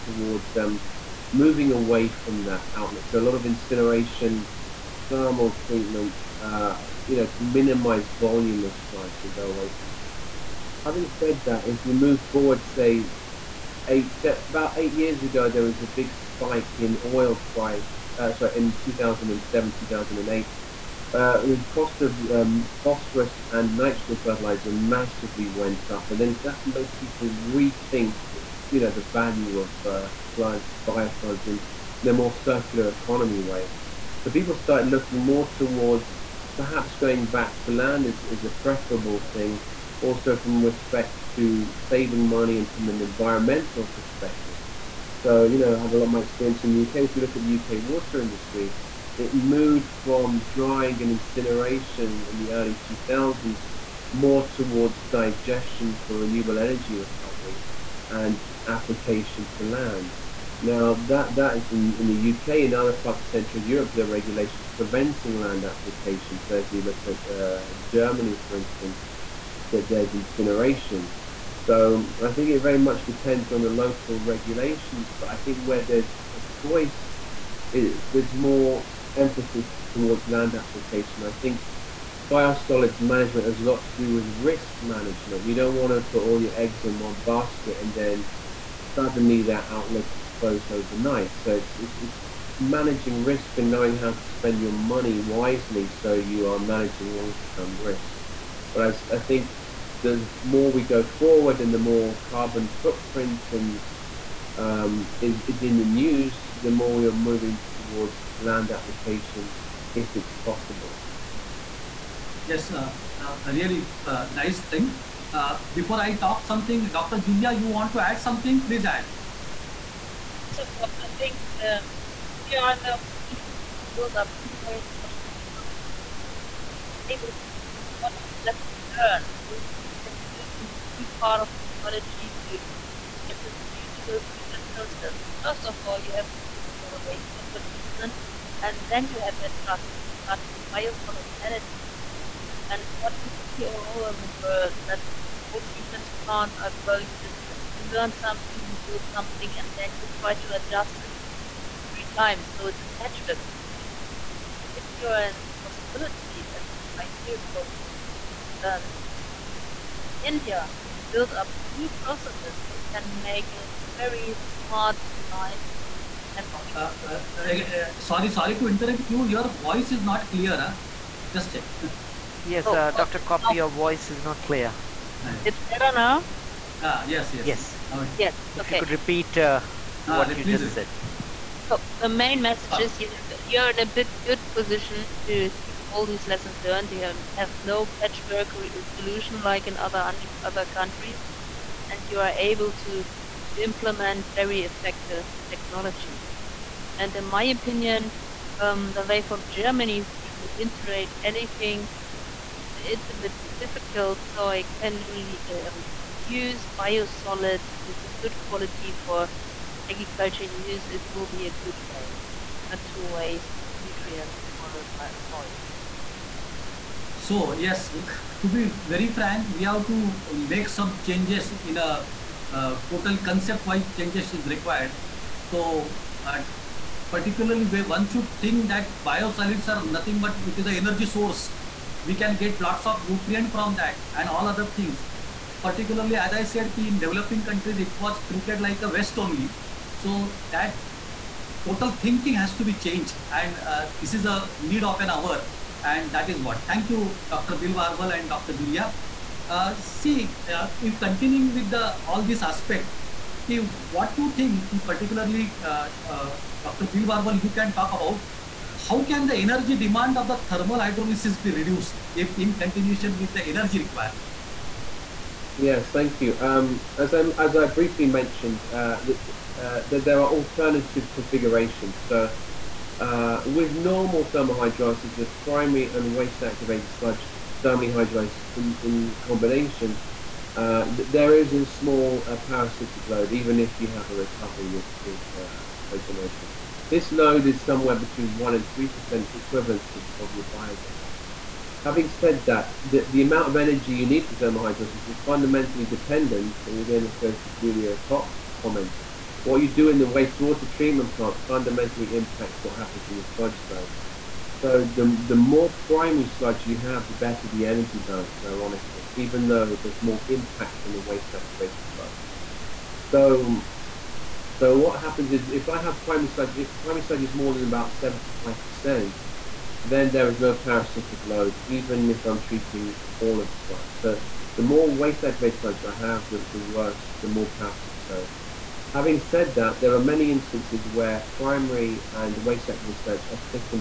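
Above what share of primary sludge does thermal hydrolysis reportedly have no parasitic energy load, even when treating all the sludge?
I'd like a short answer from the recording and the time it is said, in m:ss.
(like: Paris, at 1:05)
75%, at 5:17.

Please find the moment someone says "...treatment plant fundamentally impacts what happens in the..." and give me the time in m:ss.
5:00.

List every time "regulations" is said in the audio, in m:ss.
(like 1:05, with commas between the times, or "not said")
1:04, 1:14.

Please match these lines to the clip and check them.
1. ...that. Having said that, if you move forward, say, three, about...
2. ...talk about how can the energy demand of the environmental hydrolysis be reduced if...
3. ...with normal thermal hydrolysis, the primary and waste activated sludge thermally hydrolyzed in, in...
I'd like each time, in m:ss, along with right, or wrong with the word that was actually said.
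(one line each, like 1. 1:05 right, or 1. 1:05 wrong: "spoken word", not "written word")
1. 0:09 wrong: "eight", not "three"
2. 4:17 wrong: "thermal", not "environmental"
3. 4:33 right.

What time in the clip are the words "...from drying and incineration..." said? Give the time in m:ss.
0:50.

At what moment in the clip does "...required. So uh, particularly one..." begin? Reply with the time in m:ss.
3:44.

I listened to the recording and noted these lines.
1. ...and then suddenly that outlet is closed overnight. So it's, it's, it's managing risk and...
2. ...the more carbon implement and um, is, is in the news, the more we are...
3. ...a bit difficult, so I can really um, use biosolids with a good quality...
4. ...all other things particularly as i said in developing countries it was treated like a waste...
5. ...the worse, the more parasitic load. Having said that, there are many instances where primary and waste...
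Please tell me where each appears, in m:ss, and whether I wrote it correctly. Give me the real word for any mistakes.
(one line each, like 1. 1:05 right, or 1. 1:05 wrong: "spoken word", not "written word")
1. 1:27 right
2. 1:41 wrong: "footprint", not "implement"
3. 3:23 right
4. 3:54 right
5. 5:26 right.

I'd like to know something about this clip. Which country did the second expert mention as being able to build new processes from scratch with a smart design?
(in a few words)
India.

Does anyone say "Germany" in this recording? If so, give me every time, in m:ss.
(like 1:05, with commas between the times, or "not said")
1:07, 3:19.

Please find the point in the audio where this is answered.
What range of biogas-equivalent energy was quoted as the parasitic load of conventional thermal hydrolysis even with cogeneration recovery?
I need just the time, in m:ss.
4:47.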